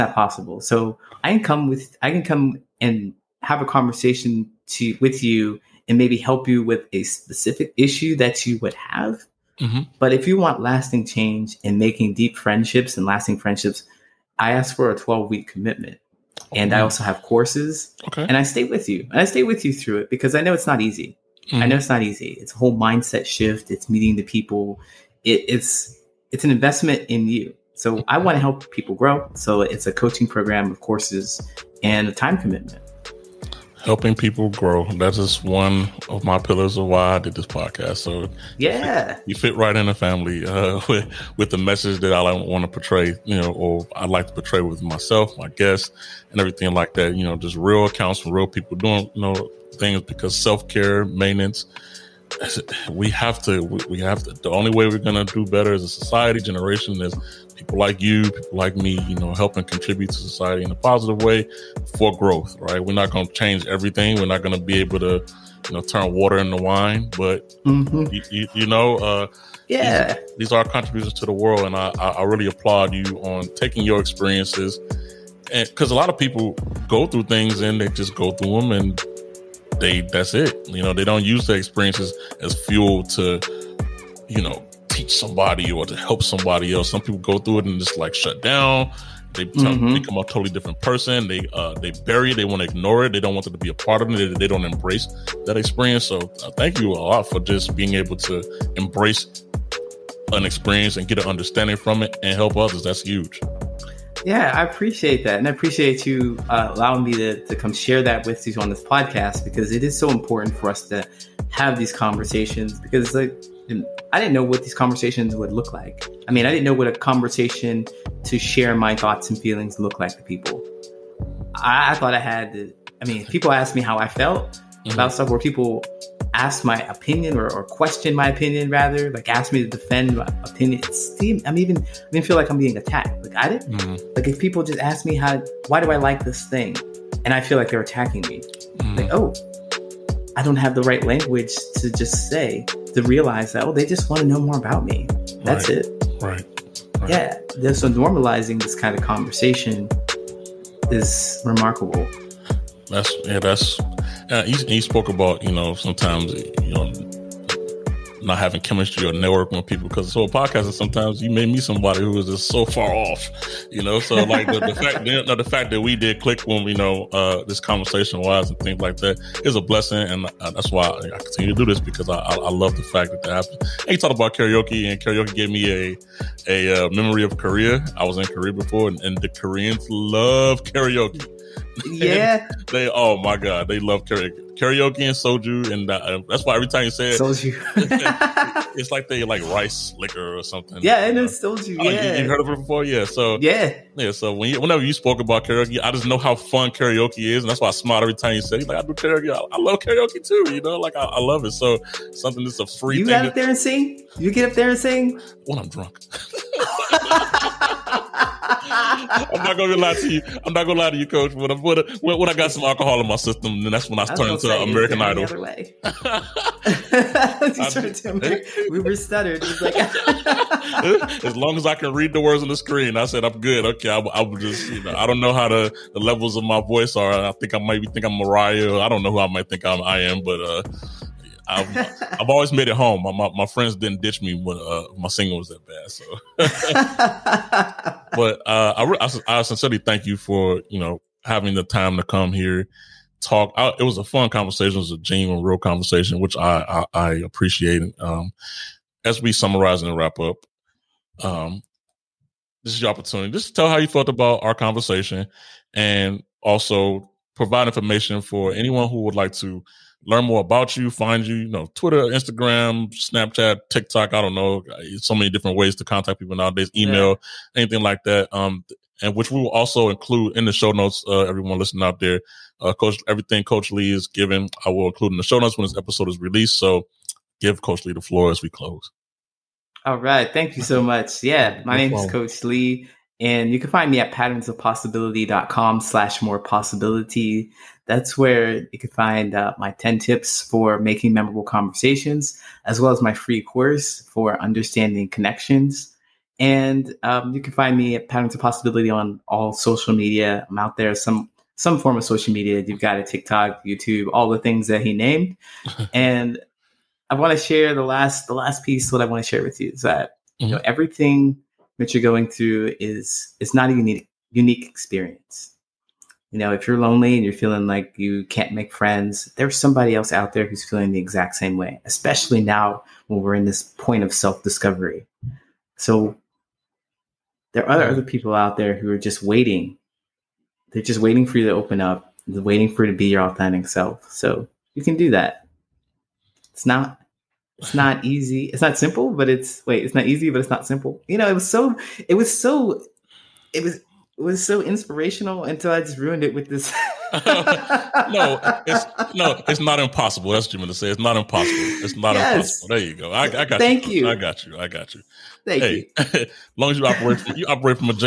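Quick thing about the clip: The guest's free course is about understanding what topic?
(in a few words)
Connections.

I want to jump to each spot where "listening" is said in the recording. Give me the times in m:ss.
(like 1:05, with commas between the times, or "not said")
4:31.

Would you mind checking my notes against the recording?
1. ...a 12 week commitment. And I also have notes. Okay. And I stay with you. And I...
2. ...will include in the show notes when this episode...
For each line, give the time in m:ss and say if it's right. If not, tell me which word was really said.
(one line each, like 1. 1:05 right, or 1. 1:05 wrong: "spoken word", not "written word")
1. 0:14 wrong: "courses", not "notes"
2. 4:34 right.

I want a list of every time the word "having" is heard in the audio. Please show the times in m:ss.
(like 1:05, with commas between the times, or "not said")
2:38, 4:01.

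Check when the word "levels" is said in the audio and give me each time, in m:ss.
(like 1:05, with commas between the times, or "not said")
3:46.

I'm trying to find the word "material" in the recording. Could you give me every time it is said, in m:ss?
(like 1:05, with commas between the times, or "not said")
not said.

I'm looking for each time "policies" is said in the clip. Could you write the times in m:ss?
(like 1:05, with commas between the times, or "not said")
not said.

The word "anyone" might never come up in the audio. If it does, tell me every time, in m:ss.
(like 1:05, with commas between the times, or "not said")
4:18.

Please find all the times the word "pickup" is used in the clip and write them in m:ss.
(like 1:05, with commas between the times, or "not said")
not said.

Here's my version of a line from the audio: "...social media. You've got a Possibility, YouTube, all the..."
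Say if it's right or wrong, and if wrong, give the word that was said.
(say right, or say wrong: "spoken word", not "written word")
wrong: "TikTok", not "Possibility".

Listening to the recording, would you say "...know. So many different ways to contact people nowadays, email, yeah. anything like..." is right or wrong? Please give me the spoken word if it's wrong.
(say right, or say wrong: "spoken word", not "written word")
right.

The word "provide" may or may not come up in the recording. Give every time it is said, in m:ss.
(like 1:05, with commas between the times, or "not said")
4:17.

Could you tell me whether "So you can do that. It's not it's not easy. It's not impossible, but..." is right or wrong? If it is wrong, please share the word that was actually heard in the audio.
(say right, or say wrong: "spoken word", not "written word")
wrong: "simple", not "impossible".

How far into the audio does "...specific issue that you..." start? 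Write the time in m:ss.
0:07.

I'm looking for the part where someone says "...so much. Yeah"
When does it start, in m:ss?
4:40.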